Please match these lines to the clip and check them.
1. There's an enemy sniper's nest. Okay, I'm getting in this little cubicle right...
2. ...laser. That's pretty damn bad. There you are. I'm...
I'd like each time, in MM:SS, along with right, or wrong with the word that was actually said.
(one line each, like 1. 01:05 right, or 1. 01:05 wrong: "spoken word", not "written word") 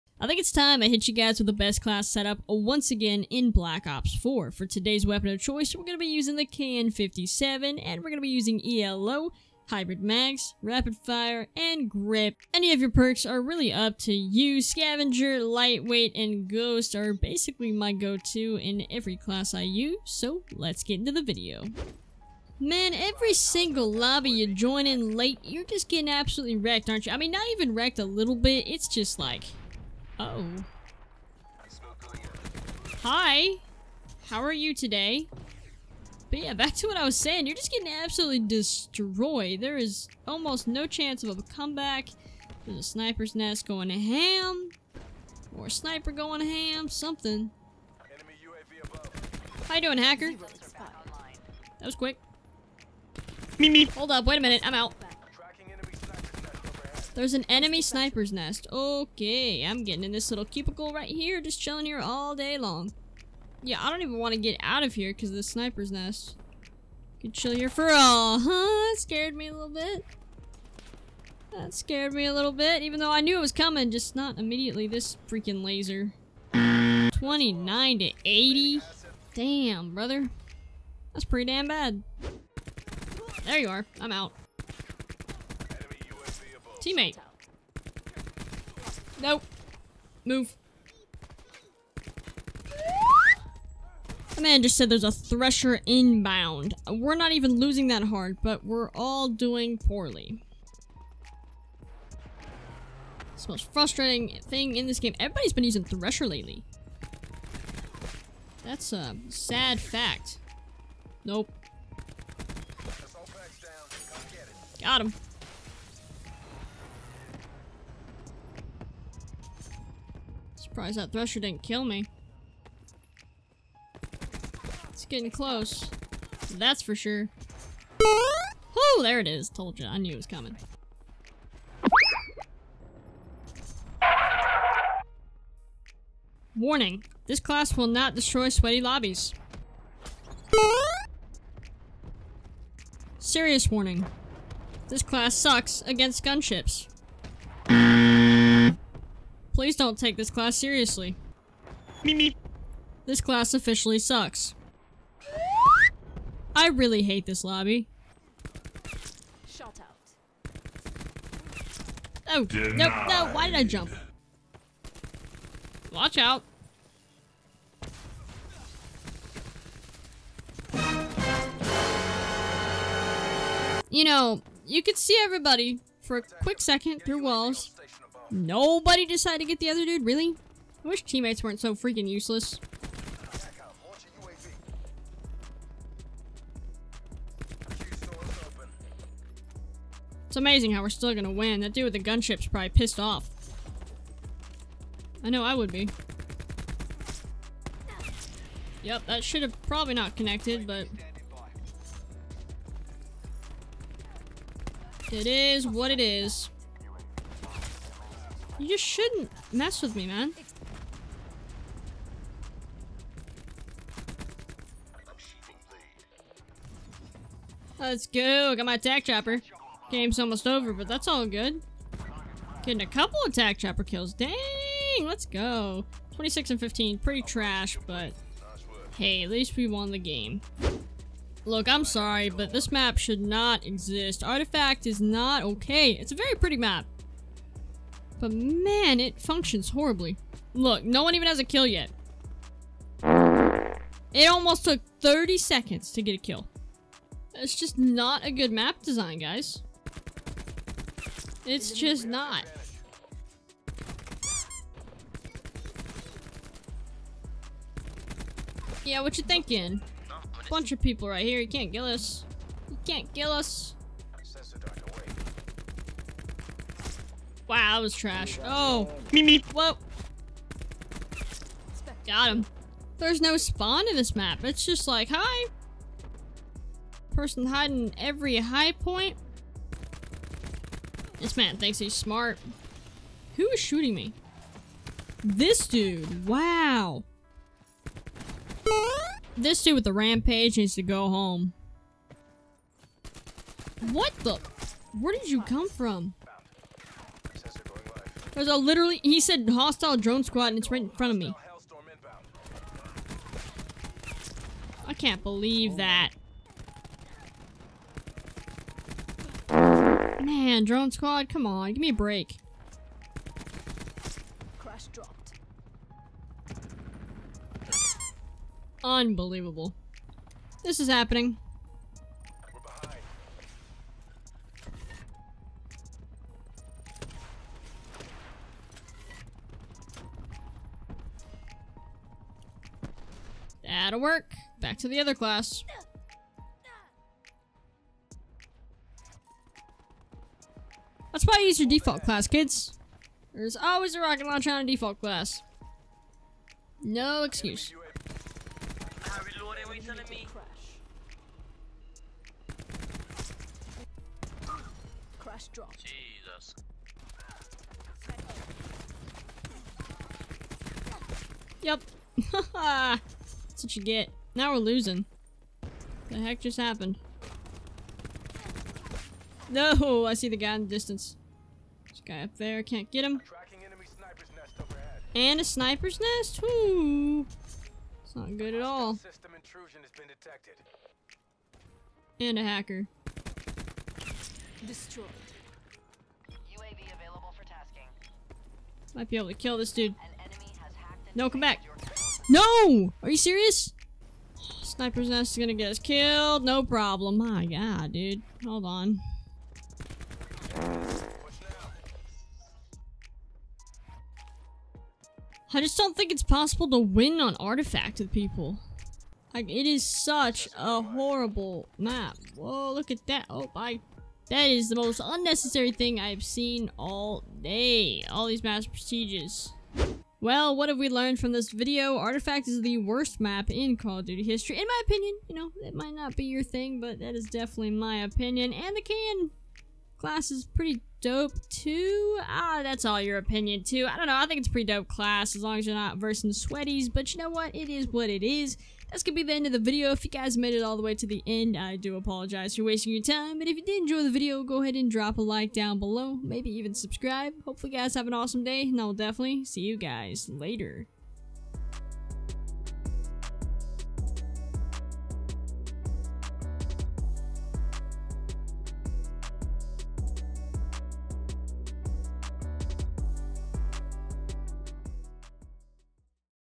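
1. 00:57 right
2. 01:19 wrong: "brother", not "laser".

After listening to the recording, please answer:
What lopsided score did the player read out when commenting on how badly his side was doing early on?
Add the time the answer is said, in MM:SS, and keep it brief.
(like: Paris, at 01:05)
29 to 80, at 01:16.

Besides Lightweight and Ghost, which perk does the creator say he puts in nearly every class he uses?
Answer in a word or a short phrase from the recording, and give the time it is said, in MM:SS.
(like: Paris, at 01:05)
Scavenger, at 00:14.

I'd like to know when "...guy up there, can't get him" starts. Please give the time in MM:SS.
06:12.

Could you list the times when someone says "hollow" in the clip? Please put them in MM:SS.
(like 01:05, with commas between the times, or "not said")
not said.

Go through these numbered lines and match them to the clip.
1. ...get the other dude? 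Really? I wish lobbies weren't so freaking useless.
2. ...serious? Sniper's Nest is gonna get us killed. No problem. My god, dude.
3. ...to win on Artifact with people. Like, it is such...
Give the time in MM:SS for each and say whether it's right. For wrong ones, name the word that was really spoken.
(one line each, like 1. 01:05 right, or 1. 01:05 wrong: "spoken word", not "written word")
1. 02:59 wrong: "teammates", not "lobbies"
2. 06:33 right
3. 06:46 right.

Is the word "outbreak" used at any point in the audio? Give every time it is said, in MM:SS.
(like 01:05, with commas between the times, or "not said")
not said.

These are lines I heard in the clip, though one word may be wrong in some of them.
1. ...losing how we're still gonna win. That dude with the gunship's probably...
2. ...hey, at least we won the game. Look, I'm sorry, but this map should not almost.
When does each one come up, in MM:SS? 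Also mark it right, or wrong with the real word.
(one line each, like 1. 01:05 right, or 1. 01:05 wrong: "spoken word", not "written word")
1. 03:10 wrong: "amazing", not "losing"
2. 03:48 wrong: "exist", not "almost".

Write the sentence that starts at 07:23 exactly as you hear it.
But if you did enjoy the video, go ahead and drop a like down below.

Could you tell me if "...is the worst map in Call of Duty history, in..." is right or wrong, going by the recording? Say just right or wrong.
right.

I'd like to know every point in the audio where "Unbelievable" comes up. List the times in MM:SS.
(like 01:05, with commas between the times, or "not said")
05:18.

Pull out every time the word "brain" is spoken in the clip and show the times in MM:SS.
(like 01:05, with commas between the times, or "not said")
not said.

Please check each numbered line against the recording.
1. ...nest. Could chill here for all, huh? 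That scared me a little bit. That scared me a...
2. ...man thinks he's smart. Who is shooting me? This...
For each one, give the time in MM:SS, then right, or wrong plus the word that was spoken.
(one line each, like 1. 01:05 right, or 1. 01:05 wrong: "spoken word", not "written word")
1. 01:05 right
2. 04:41 right.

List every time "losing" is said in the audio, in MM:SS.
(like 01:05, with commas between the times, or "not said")
01:37, 06:04.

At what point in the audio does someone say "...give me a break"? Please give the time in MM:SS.
05:11.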